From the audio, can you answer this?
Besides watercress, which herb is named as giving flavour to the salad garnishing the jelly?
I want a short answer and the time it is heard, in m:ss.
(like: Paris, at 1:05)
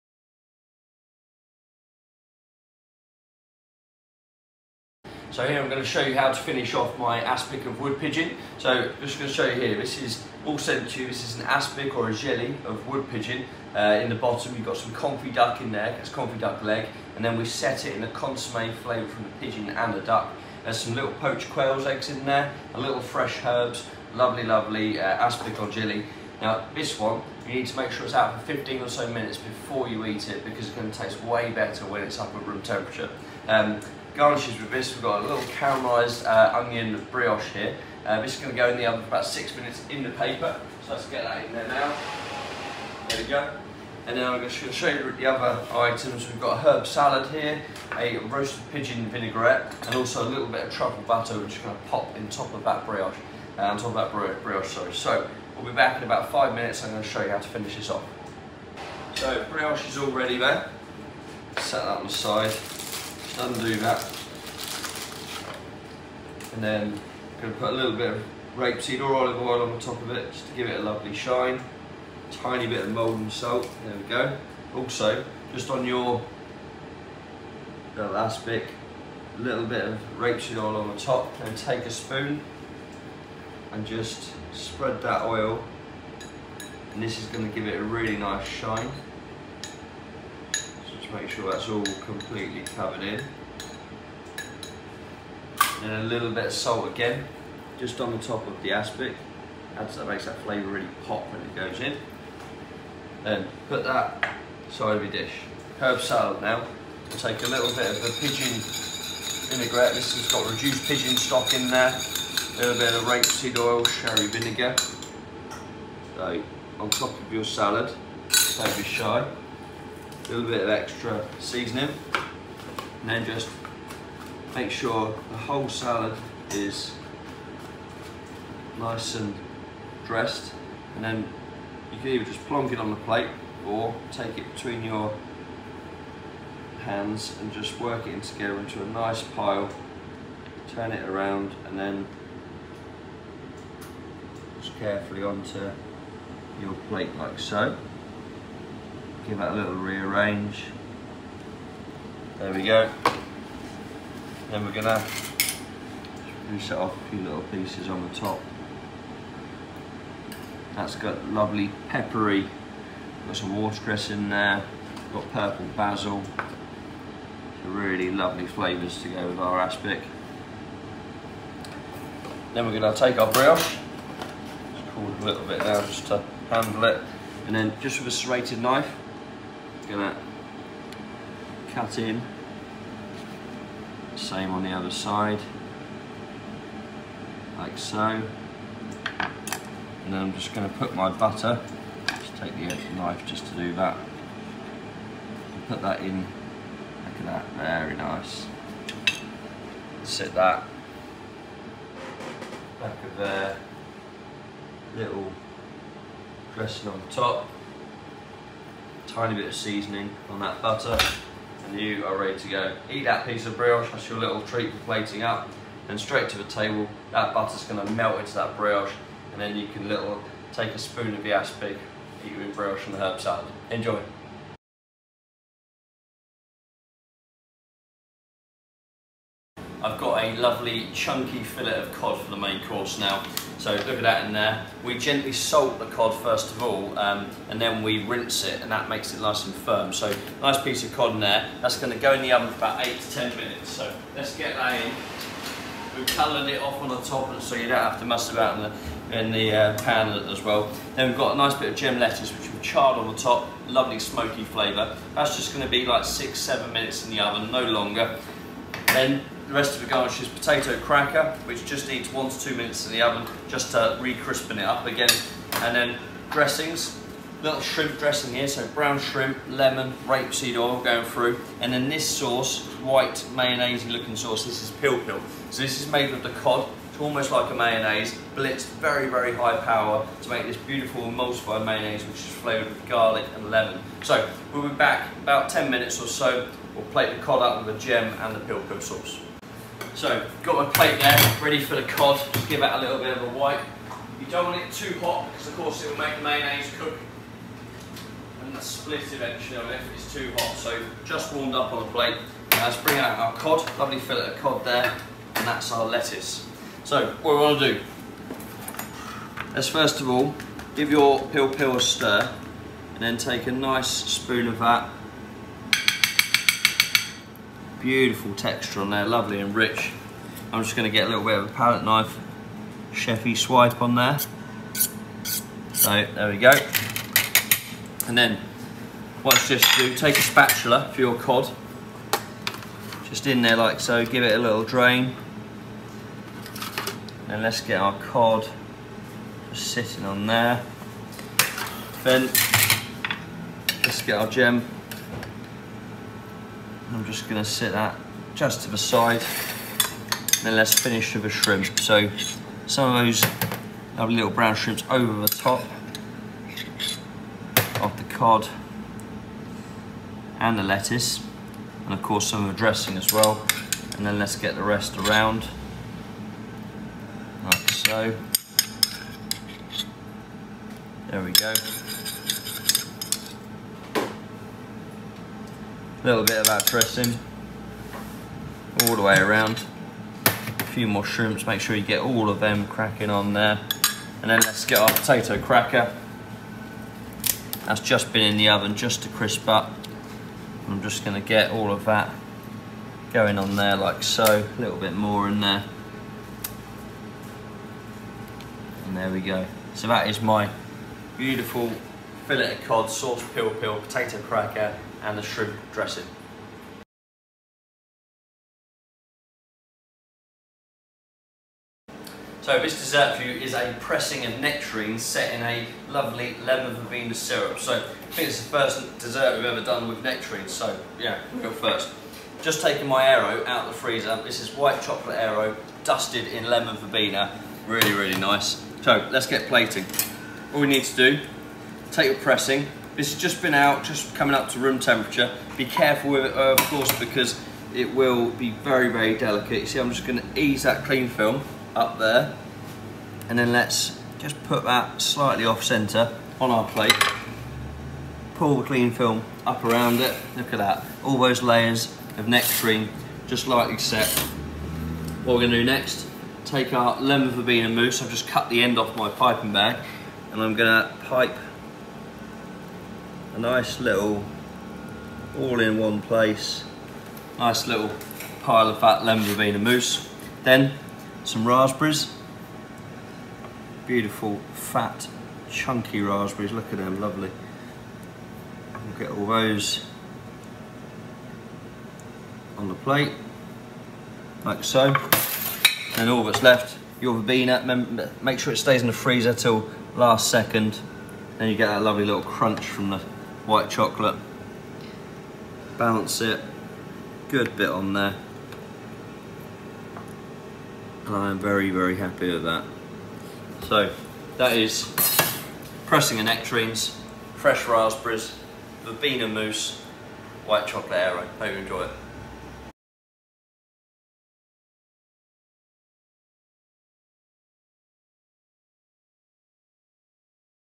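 purple basil, at 2:45.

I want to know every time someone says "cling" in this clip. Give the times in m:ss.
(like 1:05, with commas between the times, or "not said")
7:20, 7:28.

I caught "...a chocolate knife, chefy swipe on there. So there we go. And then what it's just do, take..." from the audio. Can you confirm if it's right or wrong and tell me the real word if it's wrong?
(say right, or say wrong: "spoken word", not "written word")
wrong: "palette", not "chocolate".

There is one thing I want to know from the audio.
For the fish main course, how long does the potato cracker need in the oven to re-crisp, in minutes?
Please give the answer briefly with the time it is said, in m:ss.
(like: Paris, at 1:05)
1 to 2, at 4:22.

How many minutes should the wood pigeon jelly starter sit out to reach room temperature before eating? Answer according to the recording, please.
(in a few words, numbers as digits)
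15.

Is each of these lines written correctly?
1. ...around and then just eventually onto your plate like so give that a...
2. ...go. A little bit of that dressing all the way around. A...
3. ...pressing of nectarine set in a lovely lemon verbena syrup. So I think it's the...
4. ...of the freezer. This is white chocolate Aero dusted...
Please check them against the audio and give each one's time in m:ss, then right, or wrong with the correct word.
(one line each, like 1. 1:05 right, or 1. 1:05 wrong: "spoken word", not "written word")
1. 2:21 wrong: "carefully", not "eventually"
2. 6:11 right
3. 6:53 right
4. 7:03 right.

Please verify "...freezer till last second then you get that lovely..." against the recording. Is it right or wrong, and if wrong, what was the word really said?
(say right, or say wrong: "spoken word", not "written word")
right.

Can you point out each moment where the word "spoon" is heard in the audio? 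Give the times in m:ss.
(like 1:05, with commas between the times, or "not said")
1:21, 3:40, 5:13.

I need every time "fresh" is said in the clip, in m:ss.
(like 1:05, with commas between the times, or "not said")
0:22, 8:27.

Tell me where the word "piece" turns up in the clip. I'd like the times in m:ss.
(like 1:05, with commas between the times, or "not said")
2:37, 3:33, 4:00.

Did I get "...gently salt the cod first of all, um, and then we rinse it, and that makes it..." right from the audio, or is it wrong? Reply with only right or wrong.
right.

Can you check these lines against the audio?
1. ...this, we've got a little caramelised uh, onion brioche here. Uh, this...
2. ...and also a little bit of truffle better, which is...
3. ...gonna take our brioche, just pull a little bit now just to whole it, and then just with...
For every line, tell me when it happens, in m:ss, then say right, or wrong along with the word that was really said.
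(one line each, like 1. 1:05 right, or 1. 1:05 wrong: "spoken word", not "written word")
1. 0:34 right
2. 0:49 wrong: "butter", not "better"
3. 2:52 wrong: "handle", not "whole".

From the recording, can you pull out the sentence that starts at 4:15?
That's just going to be like six, seven minutes in the oven, no longer.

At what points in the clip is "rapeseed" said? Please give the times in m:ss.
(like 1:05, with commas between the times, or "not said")
1:08, 1:20, 1:53, 4:30.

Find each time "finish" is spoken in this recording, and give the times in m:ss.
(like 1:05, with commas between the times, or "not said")
0:06, 0:57, 5:50.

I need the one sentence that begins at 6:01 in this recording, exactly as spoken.
And of course some of the dressing as well.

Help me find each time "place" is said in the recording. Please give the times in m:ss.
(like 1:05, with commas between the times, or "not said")
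7:45.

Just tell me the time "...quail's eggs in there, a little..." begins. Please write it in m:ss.
0:21.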